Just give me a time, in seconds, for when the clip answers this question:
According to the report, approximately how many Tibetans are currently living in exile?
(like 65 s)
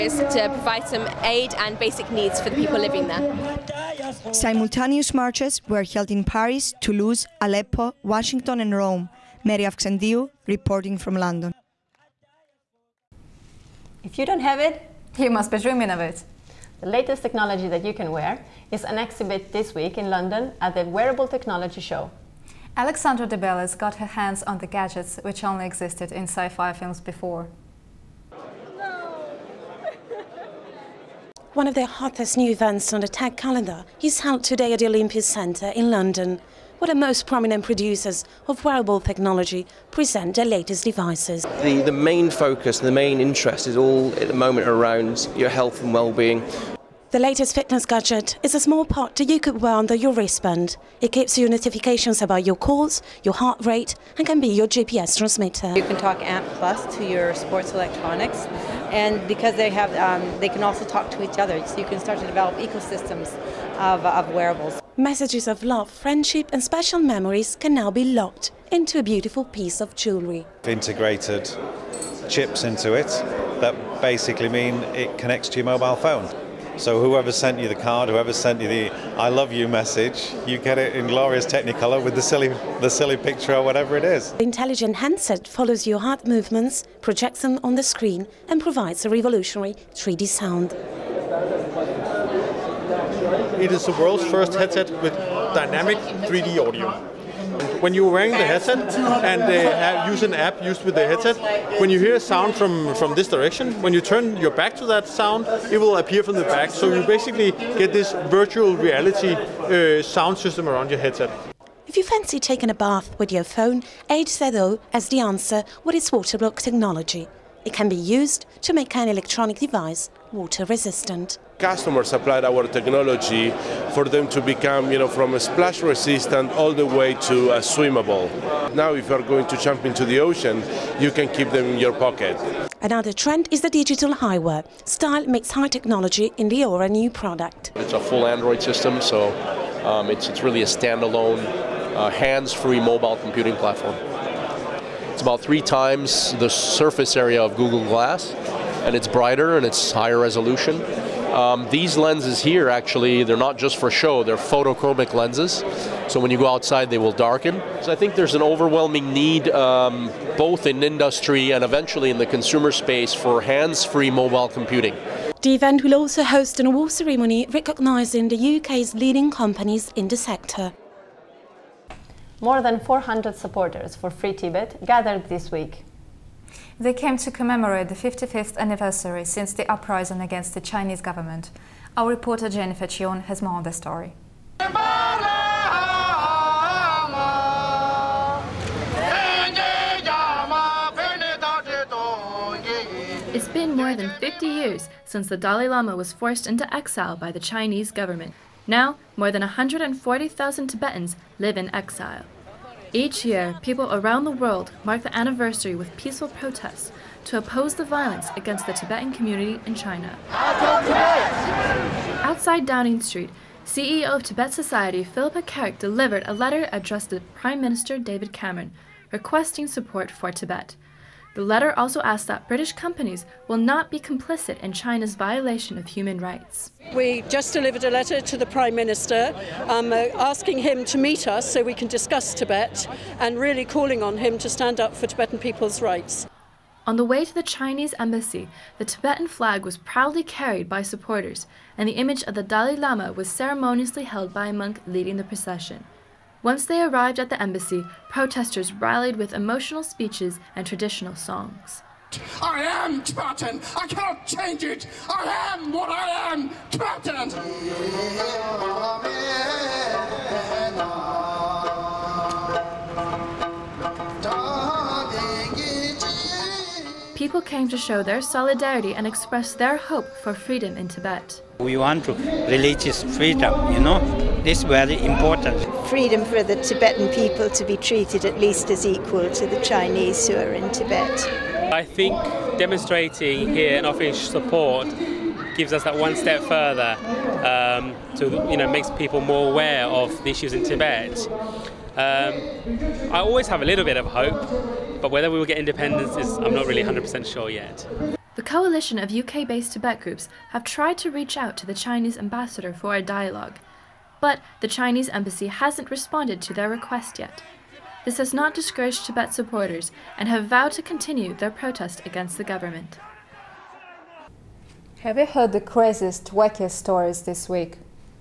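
199 s.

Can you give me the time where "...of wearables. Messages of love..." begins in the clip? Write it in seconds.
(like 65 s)
64 s.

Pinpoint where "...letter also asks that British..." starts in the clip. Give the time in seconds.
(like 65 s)
221 s.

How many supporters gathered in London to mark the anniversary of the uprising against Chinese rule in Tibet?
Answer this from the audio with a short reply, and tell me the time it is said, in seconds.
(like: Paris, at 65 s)
more than 400, at 172 s.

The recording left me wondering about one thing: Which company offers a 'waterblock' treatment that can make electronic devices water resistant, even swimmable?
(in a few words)
Age.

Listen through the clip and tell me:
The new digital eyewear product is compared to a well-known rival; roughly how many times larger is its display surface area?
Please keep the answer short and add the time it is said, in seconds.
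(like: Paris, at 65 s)
3, at 145 s.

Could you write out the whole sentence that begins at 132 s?
Another trend is the digital eyewear.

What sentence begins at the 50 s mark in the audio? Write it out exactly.
It gives you notifications about your calls, your heart rate, and can be your GPS transmitter.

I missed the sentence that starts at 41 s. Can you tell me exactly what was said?
The, the main focus, the main interest is all at the moment around your health and well-being.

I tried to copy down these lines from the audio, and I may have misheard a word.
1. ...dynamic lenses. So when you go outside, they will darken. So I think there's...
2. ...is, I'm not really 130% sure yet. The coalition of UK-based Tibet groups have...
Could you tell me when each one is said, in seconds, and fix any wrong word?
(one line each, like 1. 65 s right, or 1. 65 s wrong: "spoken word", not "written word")
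1. 154 s wrong: "photochromic", not "dynamic"
2. 296 s wrong: "100", not "130".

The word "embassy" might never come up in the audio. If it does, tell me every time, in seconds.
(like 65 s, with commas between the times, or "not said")
237 s, 247 s, 305 s.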